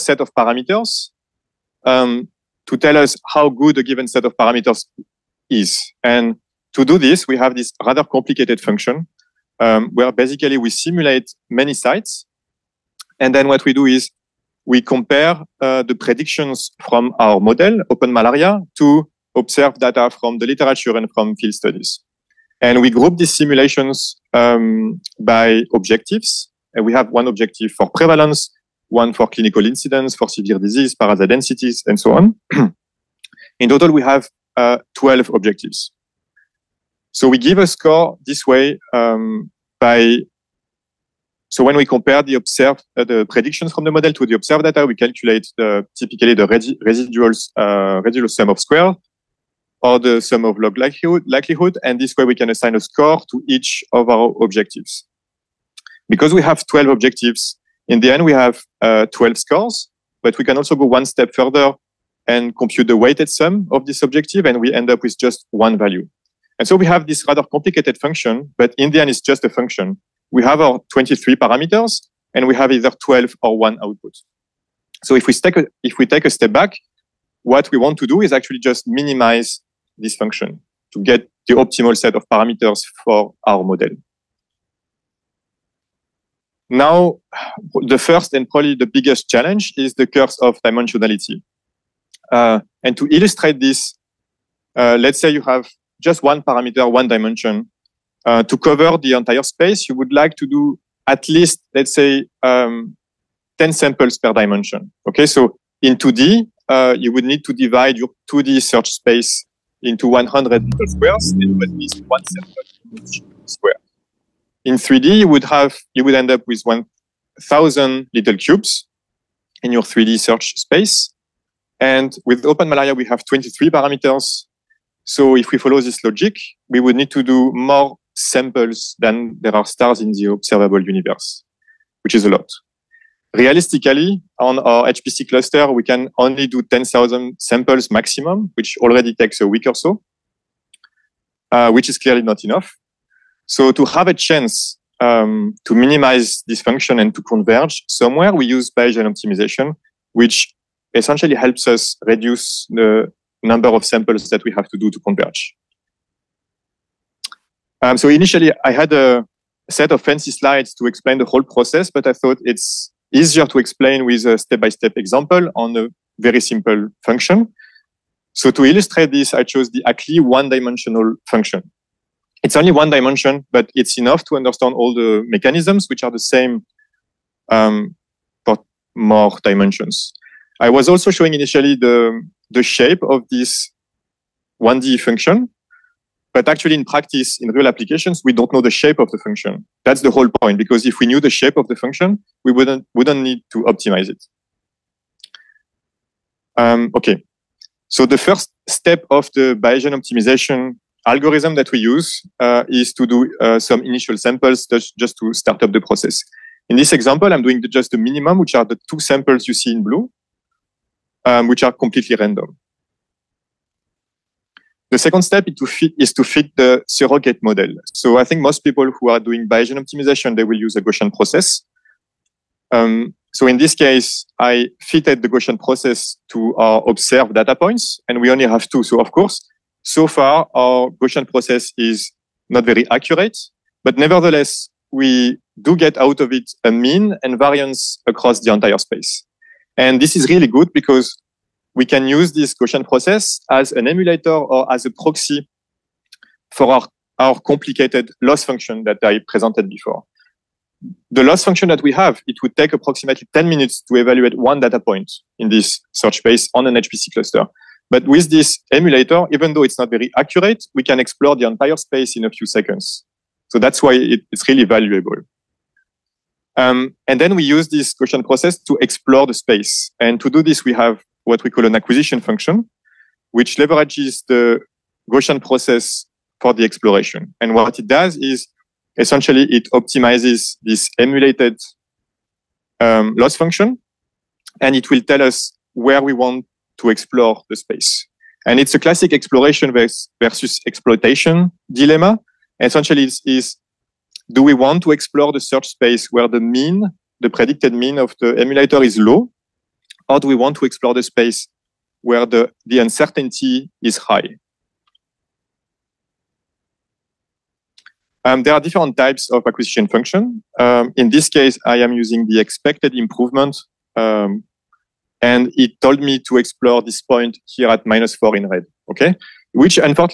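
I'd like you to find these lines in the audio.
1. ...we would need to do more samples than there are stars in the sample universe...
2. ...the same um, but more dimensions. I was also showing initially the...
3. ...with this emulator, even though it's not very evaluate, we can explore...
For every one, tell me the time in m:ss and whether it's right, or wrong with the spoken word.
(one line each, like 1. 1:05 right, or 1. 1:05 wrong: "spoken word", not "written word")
1. 2:06 wrong: "observable", not "sample"
2. 2:56 right
3. 4:18 wrong: "accurate", not "evaluate".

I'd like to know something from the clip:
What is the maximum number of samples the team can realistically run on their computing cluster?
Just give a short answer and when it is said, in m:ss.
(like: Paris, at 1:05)
10,000, at 2:16.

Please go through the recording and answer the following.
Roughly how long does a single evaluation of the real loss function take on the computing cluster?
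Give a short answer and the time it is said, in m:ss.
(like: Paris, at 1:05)
10 minutes, at 4:13.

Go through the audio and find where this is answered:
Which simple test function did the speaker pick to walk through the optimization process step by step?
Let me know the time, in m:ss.
2:49.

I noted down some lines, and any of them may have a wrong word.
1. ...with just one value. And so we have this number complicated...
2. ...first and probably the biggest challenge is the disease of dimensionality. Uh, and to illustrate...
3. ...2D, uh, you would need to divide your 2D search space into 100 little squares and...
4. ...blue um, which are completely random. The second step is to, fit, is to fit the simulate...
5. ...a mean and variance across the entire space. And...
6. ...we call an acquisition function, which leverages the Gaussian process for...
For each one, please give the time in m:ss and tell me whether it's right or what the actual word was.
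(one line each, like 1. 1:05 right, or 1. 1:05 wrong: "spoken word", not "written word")
1. 1:05 wrong: "rather", not "number"
2. 1:27 wrong: "curse", not "disease"
3. 1:45 right
4. 3:29 wrong: "surrogate", not "simulate"
5. 3:56 right
6. 4:31 right.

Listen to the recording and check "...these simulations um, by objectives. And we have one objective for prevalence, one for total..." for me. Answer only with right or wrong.
wrong.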